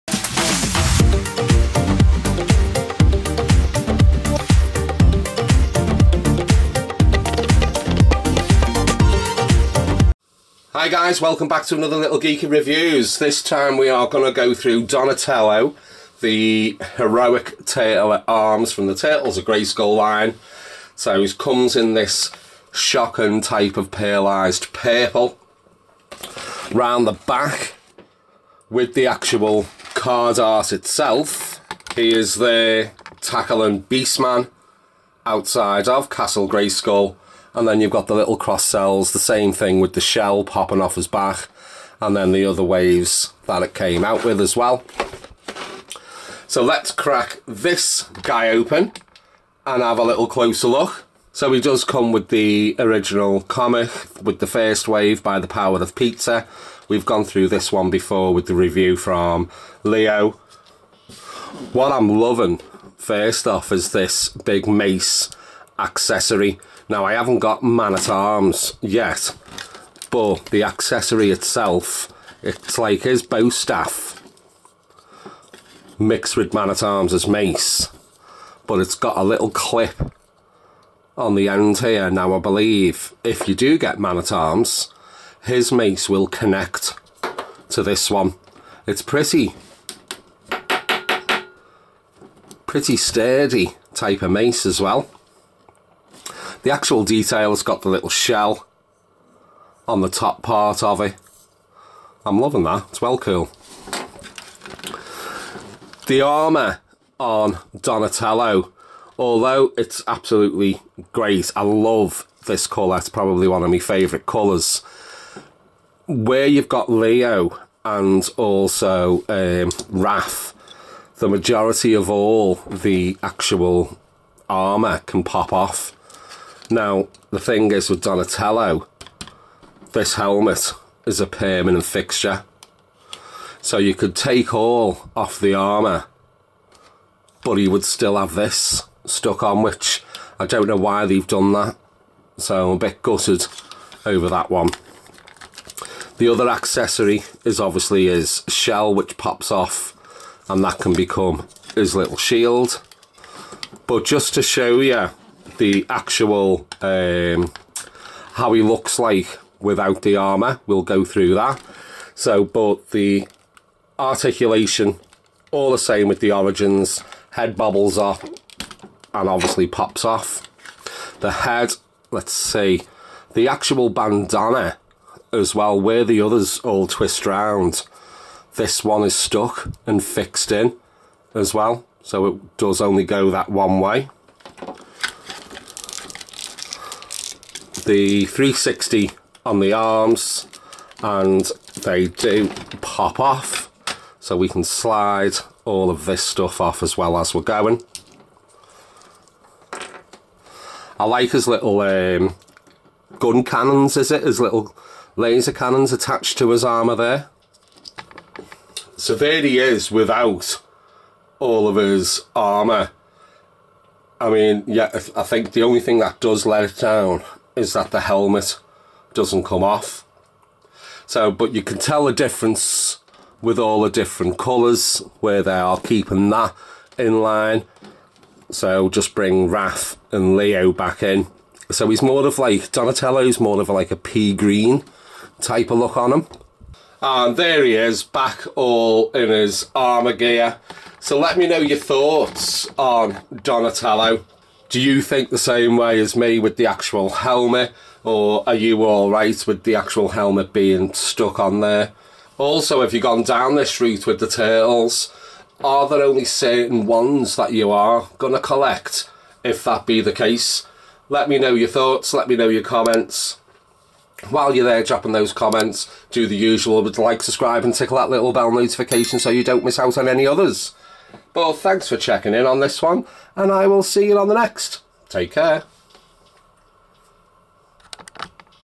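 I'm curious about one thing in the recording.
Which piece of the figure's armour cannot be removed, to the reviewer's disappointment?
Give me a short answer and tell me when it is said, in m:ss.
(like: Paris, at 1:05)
the helmet, at 2:09.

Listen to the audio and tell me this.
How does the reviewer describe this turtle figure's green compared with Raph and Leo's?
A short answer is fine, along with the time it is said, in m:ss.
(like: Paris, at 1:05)
pea green, at 3:53.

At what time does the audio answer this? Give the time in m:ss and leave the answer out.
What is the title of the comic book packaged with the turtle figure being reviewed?
0:55.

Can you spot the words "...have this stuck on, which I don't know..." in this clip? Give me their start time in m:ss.
2:18.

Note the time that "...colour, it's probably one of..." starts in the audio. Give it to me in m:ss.
1:52.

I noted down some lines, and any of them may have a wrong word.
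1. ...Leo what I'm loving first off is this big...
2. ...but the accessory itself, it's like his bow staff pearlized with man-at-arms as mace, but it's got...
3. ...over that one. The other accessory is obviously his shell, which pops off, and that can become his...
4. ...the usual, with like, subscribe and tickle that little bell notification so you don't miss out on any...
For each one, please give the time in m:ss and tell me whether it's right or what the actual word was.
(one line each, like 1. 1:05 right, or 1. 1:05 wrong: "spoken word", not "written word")
1. 0:59 right
2. 1:10 wrong: "mixed", not "pearlized"
3. 2:24 right
4. 4:26 right.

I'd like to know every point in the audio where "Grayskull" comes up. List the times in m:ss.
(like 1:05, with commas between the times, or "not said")
0:19, 0:36.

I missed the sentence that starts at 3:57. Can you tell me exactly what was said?
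And there he is, back all in his armour gear.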